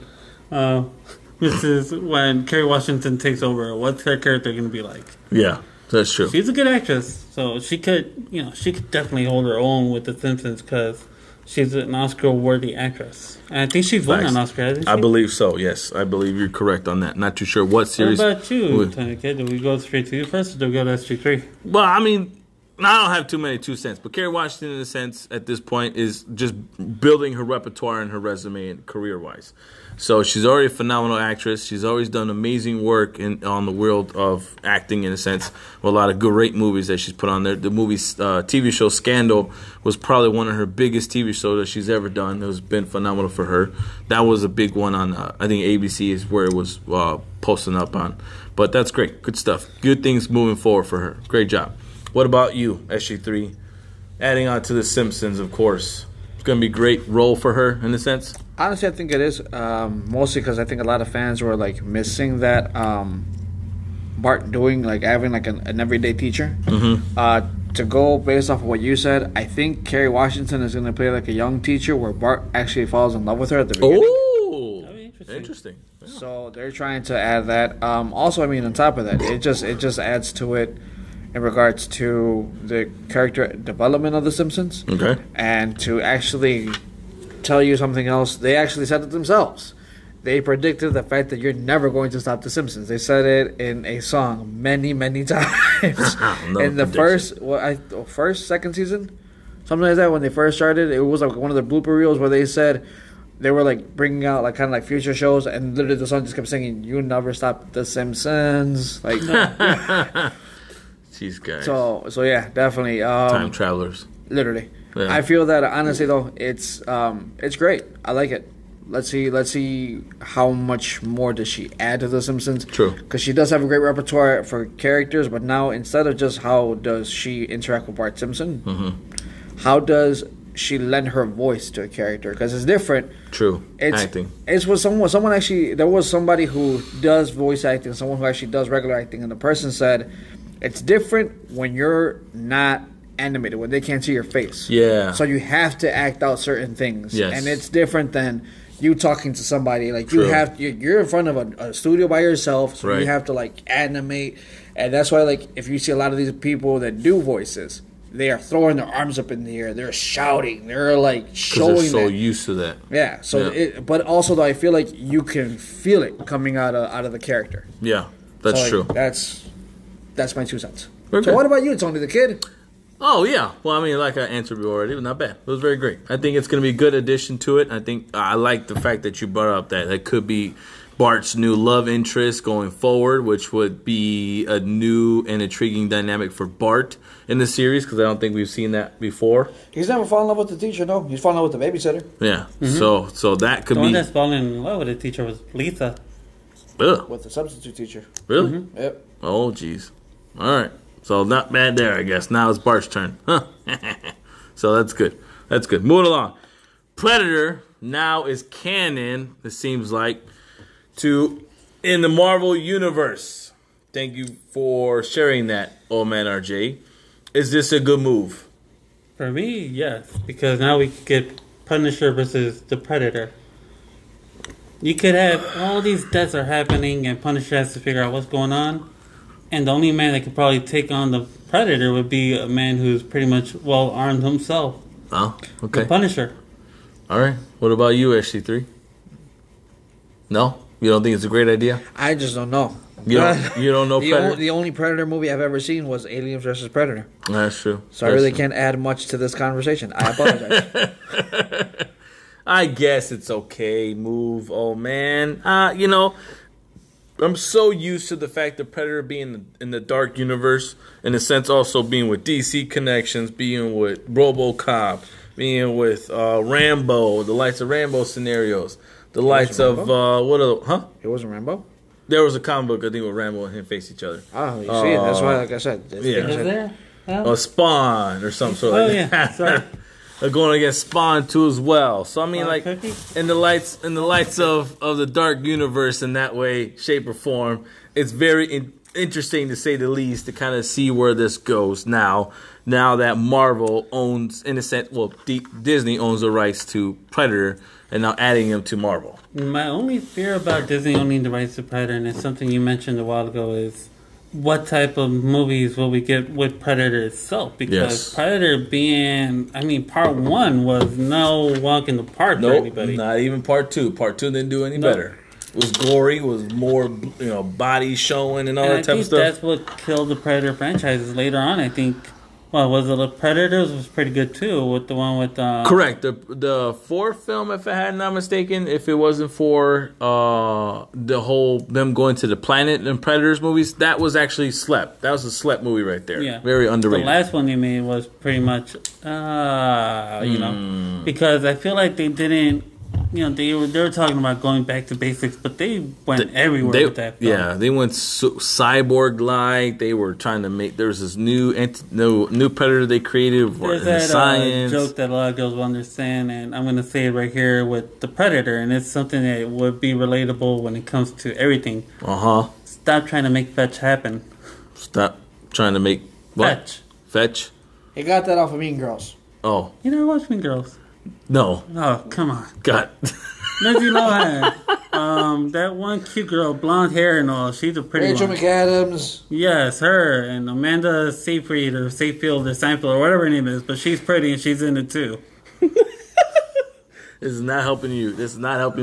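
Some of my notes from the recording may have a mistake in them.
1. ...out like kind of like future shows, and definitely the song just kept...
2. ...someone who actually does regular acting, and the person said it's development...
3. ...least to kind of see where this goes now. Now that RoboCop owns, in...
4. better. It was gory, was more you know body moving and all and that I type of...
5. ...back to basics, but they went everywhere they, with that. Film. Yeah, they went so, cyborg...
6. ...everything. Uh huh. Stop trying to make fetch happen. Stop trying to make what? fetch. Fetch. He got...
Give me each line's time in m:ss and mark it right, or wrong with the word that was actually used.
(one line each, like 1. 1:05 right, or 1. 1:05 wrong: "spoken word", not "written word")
1. 1:44 wrong: "literally", not "definitely"
2. 2:17 wrong: "different", not "development"
3. 4:49 wrong: "Marvel", not "RoboCop"
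4. 5:14 wrong: "showing", not "moving"
5. 5:44 right
6. 6:01 right.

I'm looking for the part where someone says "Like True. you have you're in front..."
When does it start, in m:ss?
2:29.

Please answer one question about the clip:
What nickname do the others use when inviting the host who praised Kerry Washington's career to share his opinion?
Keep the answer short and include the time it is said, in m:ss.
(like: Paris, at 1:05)
Tony the Kid, at 2:51.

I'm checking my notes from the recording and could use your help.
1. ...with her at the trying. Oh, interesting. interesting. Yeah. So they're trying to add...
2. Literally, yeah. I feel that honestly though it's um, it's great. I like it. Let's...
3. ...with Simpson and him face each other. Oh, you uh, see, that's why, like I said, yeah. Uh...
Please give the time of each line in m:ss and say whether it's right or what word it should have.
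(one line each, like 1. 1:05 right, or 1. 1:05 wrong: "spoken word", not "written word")
1. 1:13 wrong: "beginning", not "trying"
2. 1:54 right
3. 4:33 wrong: "Rambo", not "Simpson".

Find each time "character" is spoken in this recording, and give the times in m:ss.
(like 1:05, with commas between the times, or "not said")
0:04, 1:23, 2:04, 2:11, 2:47.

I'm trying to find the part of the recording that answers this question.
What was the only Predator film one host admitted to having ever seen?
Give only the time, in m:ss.
4:06.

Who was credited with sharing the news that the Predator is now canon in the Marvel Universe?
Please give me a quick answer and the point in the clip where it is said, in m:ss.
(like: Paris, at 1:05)
old man RJ, at 3:35.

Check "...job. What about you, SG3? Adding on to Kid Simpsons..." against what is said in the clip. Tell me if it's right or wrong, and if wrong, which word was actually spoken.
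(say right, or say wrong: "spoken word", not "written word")
wrong: "The", not "Kid".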